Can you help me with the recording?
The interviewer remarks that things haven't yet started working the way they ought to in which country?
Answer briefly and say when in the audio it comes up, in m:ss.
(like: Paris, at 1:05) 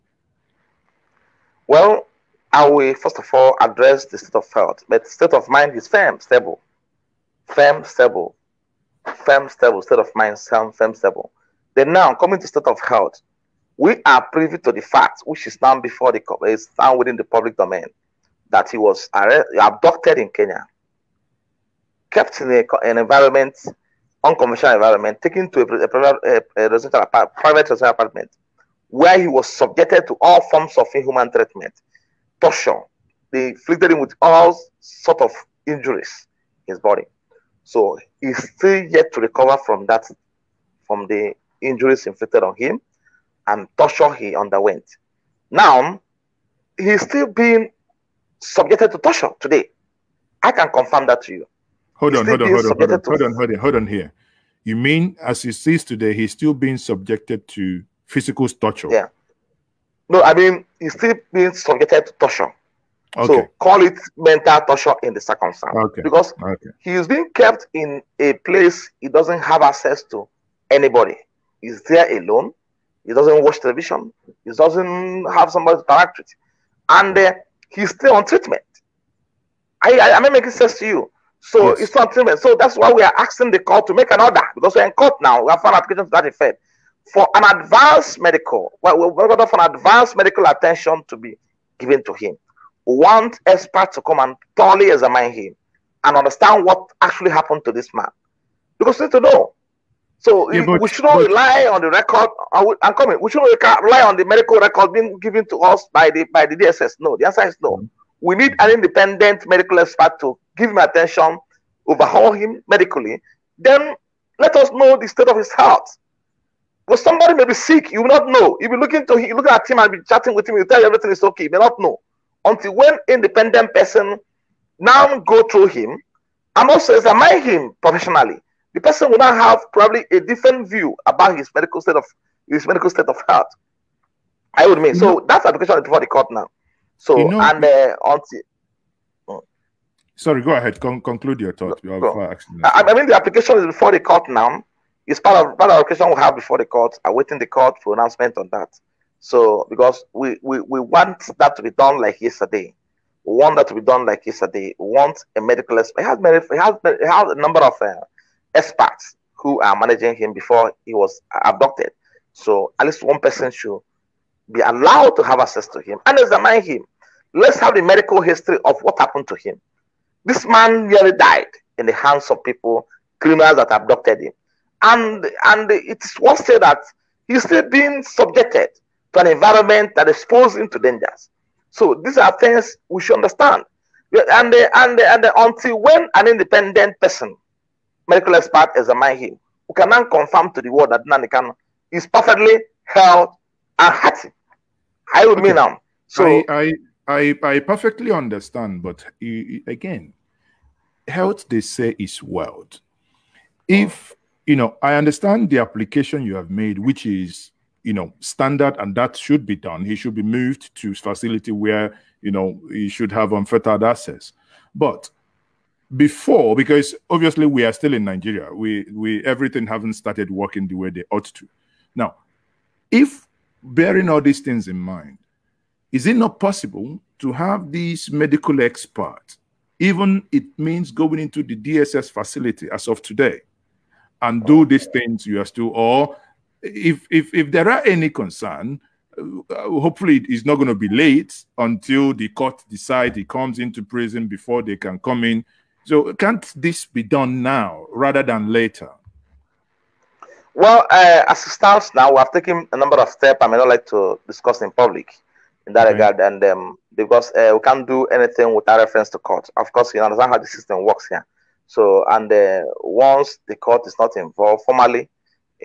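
Nigeria, at 3:38.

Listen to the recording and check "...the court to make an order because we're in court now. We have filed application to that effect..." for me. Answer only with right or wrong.
right.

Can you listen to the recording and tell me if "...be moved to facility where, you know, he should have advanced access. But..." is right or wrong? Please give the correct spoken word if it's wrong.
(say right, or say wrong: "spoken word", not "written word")
wrong: "unfettered", not "advanced".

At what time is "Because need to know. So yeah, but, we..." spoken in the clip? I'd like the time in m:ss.
1:38.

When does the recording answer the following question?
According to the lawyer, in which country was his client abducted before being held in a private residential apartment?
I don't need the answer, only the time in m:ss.
0:20.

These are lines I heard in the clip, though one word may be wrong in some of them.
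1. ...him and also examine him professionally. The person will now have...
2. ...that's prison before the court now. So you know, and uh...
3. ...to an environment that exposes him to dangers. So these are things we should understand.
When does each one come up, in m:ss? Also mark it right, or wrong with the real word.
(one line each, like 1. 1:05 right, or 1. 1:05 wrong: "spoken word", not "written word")
1. 2:05 right
2. 2:15 wrong: "application", not "prison"
3. 2:59 right.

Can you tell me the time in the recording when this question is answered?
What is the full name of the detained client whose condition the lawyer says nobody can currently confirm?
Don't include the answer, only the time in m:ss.
3:11.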